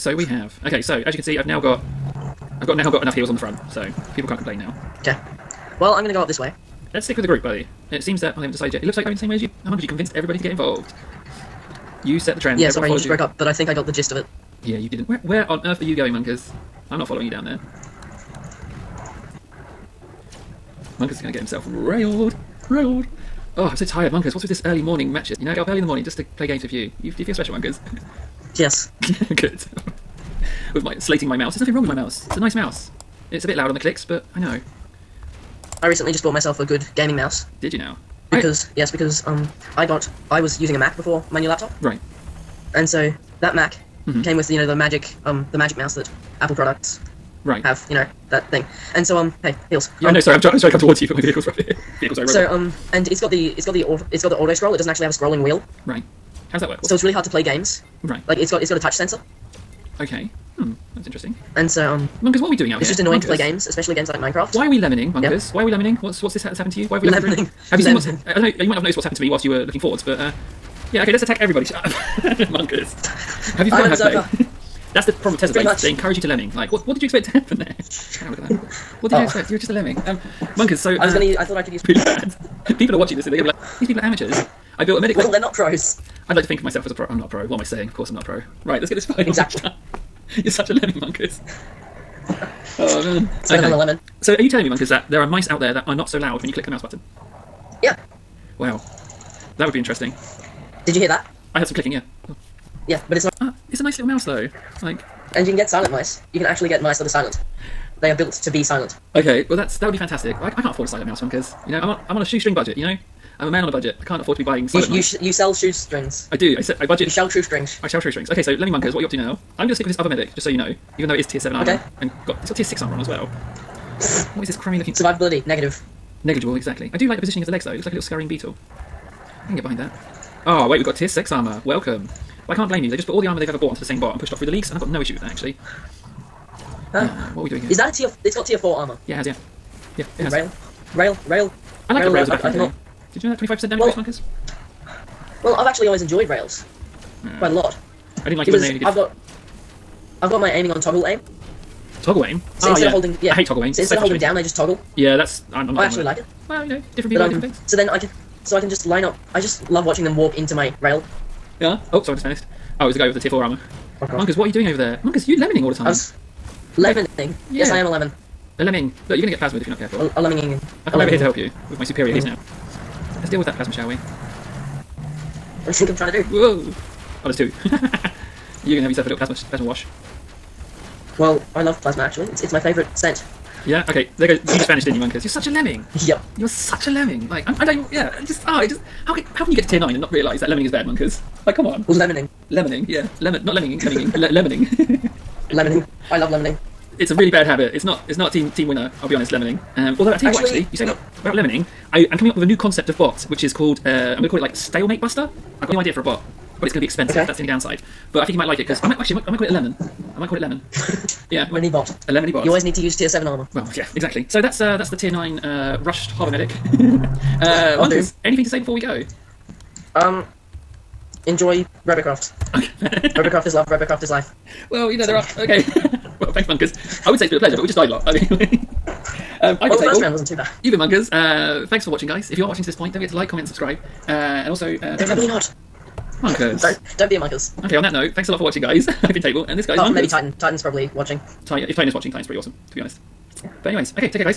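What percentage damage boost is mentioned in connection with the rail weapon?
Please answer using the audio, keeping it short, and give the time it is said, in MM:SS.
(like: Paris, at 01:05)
25%, at 02:23.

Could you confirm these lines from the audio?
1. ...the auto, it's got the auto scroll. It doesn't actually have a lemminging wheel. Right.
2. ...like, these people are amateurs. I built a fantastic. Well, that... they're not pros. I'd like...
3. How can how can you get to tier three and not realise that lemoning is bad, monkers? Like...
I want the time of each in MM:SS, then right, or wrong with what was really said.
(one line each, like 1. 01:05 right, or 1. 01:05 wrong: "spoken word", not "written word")
1. 00:53 wrong: "scrolling", not "lemminging"
2. 01:23 wrong: "medic", not "fantastic"
3. 03:09 wrong: "nine", not "three".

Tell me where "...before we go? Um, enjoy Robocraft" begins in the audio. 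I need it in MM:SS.
03:38.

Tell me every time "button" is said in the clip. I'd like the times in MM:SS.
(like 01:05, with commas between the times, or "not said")
01:36.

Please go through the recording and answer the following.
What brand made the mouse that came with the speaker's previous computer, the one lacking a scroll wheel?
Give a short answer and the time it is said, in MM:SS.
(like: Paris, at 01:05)
Apple, at 00:46.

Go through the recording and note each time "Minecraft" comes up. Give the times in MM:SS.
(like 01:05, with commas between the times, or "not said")
01:04.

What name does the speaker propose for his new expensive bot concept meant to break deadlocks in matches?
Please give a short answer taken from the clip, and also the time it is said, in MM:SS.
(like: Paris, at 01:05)
Stalemate Buster, at 03:24.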